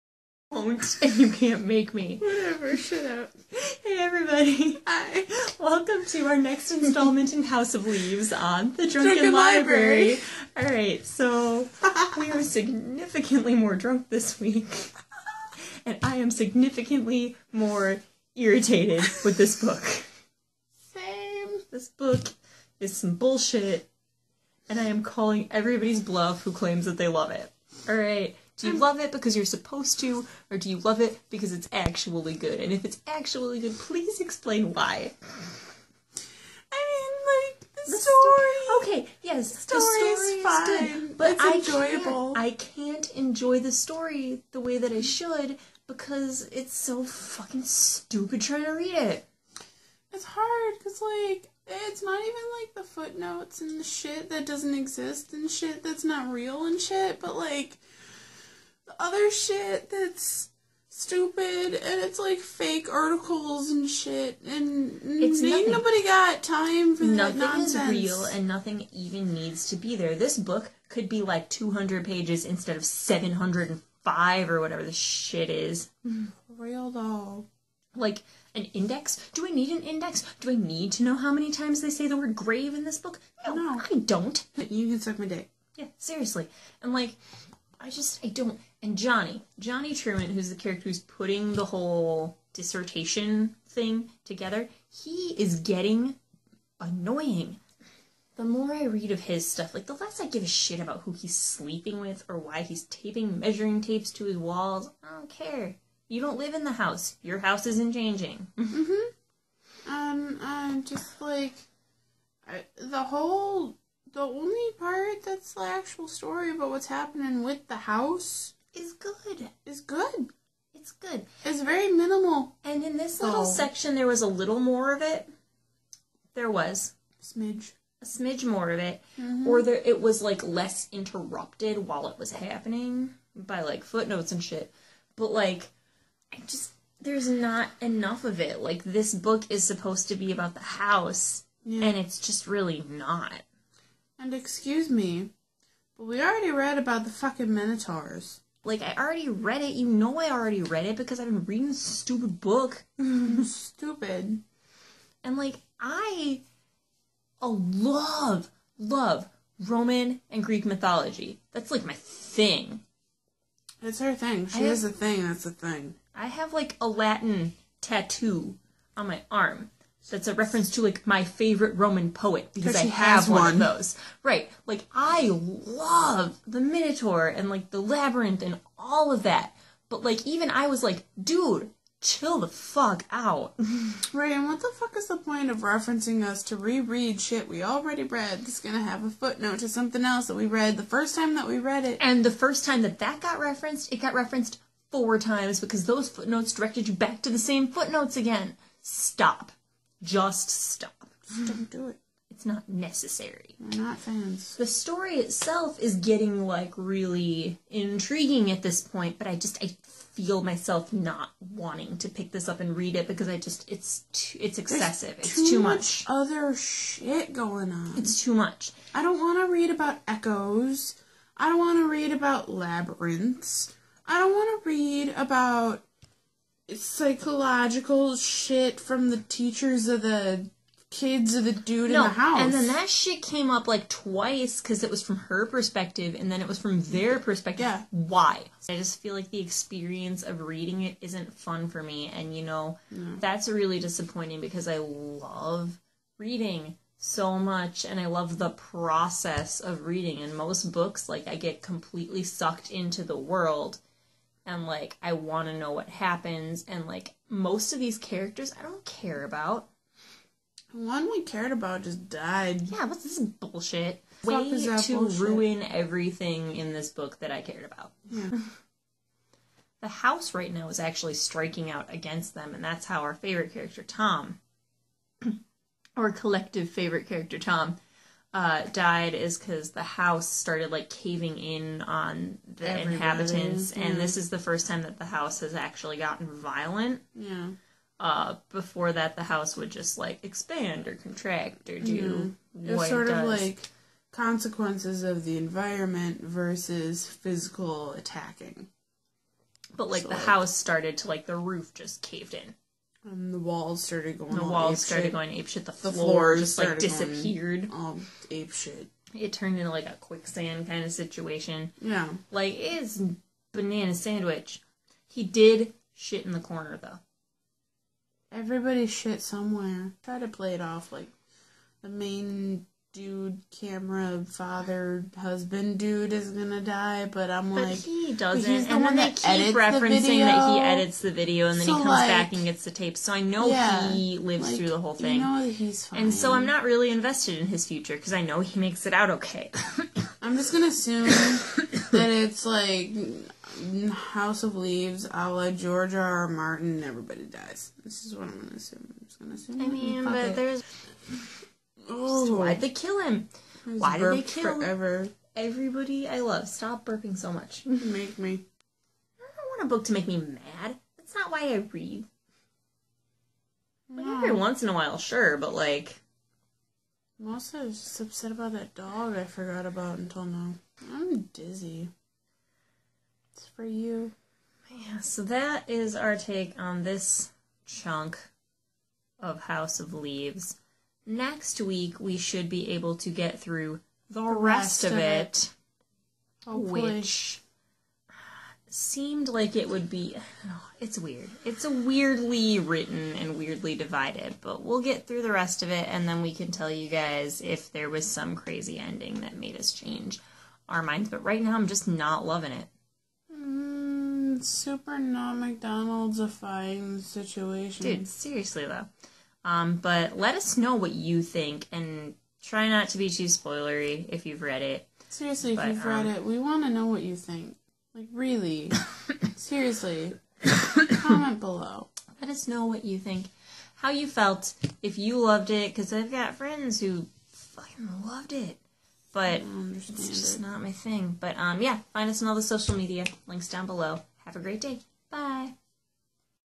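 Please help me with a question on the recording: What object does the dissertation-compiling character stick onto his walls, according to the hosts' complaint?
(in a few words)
measuring tapes.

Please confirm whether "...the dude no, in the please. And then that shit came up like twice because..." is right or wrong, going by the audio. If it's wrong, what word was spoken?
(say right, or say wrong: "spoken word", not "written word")
wrong: "house", not "please".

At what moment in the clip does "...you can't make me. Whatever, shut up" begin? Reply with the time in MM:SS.
00:01.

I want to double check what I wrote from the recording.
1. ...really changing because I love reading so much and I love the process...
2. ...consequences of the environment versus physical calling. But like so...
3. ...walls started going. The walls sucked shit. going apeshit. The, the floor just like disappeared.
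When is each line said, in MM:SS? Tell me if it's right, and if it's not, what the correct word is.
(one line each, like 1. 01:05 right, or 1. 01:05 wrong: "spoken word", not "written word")
1. 04:03 wrong: "disappointing", not "changing"
2. 04:54 wrong: "attacking", not "calling"
3. 05:03 wrong: "started", not "sucked".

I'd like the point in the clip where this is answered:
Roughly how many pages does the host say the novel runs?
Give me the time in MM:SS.
01:12.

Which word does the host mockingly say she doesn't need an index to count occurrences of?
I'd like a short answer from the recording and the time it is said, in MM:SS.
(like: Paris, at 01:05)
grave, at 01:22.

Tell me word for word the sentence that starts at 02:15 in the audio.
But like, I just there's not enough of it.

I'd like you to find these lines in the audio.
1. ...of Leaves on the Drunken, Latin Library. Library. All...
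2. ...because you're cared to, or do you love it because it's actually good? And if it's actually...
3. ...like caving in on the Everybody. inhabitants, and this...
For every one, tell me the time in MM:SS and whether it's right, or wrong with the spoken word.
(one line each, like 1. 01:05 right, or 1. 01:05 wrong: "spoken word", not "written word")
1. 00:07 wrong: "Drunken", not "Latin"
2. 00:29 wrong: "supposed", not "cared"
3. 04:40 right.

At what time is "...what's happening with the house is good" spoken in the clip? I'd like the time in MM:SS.
01:56.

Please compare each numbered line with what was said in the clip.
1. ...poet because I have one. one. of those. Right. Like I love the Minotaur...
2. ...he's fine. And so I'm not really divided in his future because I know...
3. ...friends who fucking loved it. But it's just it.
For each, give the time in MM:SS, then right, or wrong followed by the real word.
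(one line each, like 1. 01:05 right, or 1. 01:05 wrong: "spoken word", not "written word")
1. 02:52 right
2. 05:35 wrong: "invested", not "divided"
3. 07:06 right.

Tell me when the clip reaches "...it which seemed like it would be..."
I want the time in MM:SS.
06:26.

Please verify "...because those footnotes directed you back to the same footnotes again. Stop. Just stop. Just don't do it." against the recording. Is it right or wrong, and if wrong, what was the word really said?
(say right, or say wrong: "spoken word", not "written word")
right.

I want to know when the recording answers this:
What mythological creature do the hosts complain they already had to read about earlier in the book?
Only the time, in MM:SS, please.
02:27.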